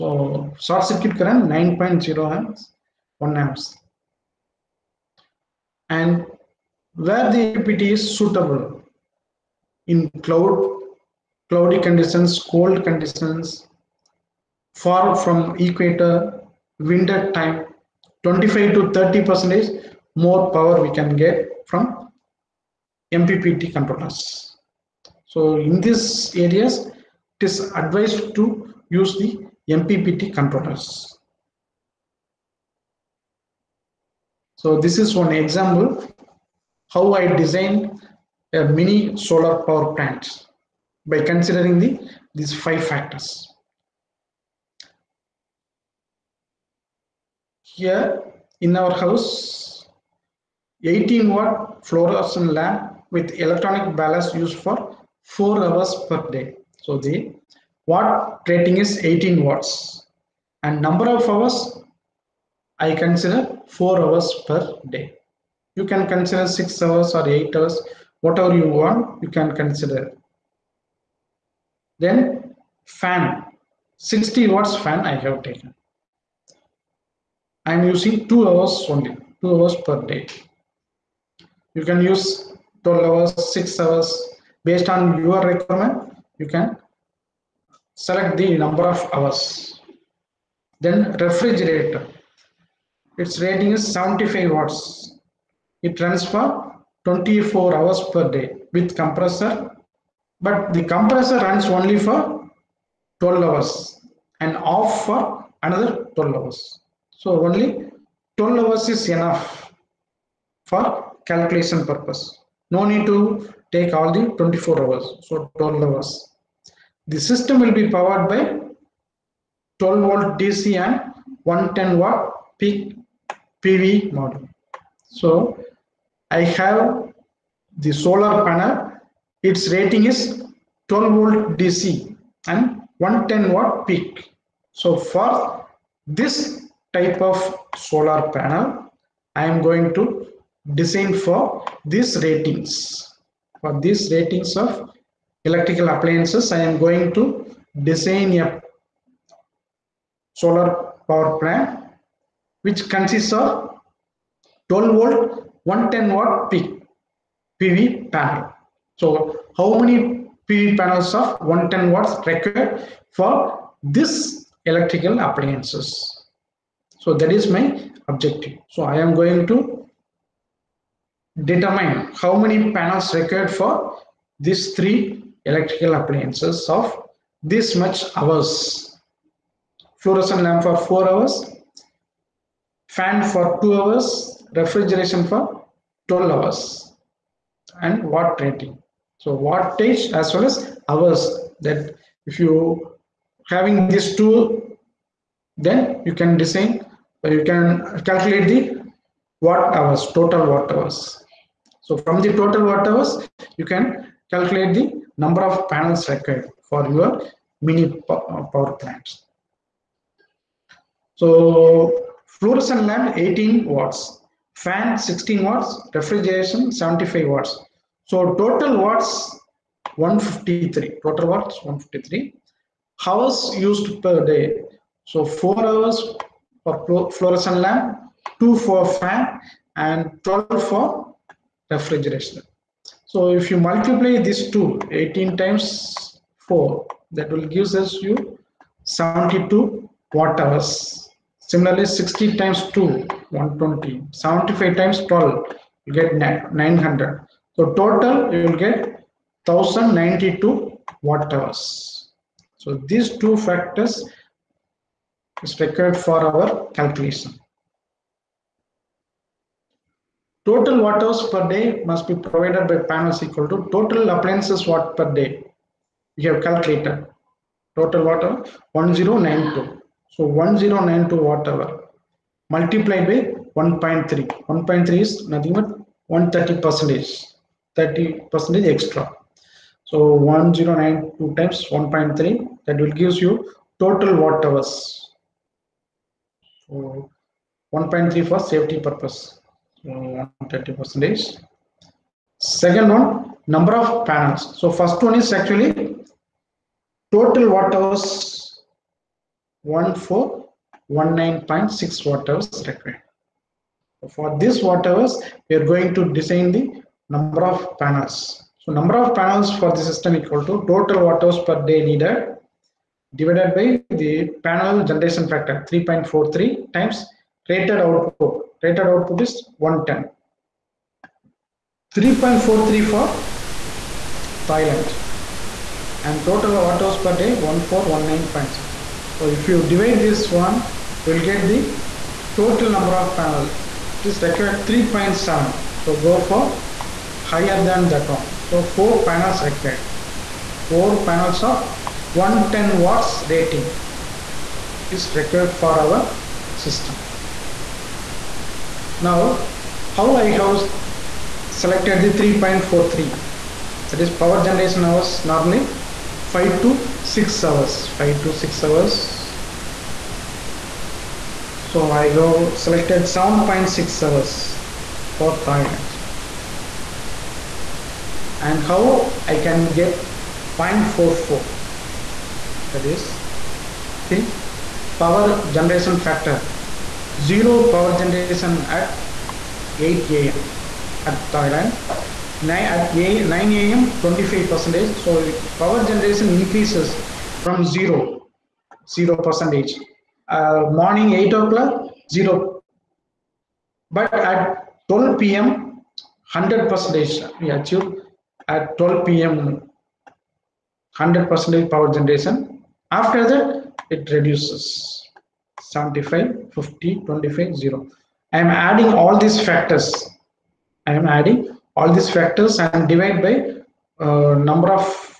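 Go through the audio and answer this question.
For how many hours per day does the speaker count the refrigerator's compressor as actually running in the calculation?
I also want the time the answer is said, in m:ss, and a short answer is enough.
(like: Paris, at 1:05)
12 hours, at 1:47.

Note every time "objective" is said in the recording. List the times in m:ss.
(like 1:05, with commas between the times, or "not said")
2:48.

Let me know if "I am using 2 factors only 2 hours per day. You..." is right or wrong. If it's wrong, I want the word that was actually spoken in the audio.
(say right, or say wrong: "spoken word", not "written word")
wrong: "hours", not "factors".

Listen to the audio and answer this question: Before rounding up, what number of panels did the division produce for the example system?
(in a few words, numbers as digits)
3.7.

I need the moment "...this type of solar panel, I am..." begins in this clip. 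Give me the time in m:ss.
2:16.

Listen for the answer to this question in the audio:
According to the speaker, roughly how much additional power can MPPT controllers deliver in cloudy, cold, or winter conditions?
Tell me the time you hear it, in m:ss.
0:18.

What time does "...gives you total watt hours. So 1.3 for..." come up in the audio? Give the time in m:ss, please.
4:43.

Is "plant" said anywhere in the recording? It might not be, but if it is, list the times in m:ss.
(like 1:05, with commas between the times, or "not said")
0:39, 2:31, 3:28.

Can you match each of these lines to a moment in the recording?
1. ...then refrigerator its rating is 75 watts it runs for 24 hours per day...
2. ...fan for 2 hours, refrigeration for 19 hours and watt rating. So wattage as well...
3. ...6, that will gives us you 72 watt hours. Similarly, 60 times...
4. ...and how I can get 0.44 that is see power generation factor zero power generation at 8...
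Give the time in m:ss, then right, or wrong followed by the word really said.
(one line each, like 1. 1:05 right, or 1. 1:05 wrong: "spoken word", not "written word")
1. 1:30 right
2. 3:02 wrong: "12", not "19"
3. 3:56 wrong: "4", not "6"
4. 6:08 right.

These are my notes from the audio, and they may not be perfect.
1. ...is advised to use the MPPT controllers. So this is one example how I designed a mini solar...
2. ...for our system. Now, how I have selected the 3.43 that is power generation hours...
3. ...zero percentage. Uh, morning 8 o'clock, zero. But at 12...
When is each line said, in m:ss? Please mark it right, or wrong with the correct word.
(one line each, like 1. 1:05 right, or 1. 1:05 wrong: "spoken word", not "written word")
1. 0:27 right
2. 5:45 right
3. 6:28 right.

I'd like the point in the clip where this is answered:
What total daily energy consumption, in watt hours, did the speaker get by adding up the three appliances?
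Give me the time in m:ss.
4:09.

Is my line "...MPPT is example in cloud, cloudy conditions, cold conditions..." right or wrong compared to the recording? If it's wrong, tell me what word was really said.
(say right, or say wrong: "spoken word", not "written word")
wrong: "suitable", not "example".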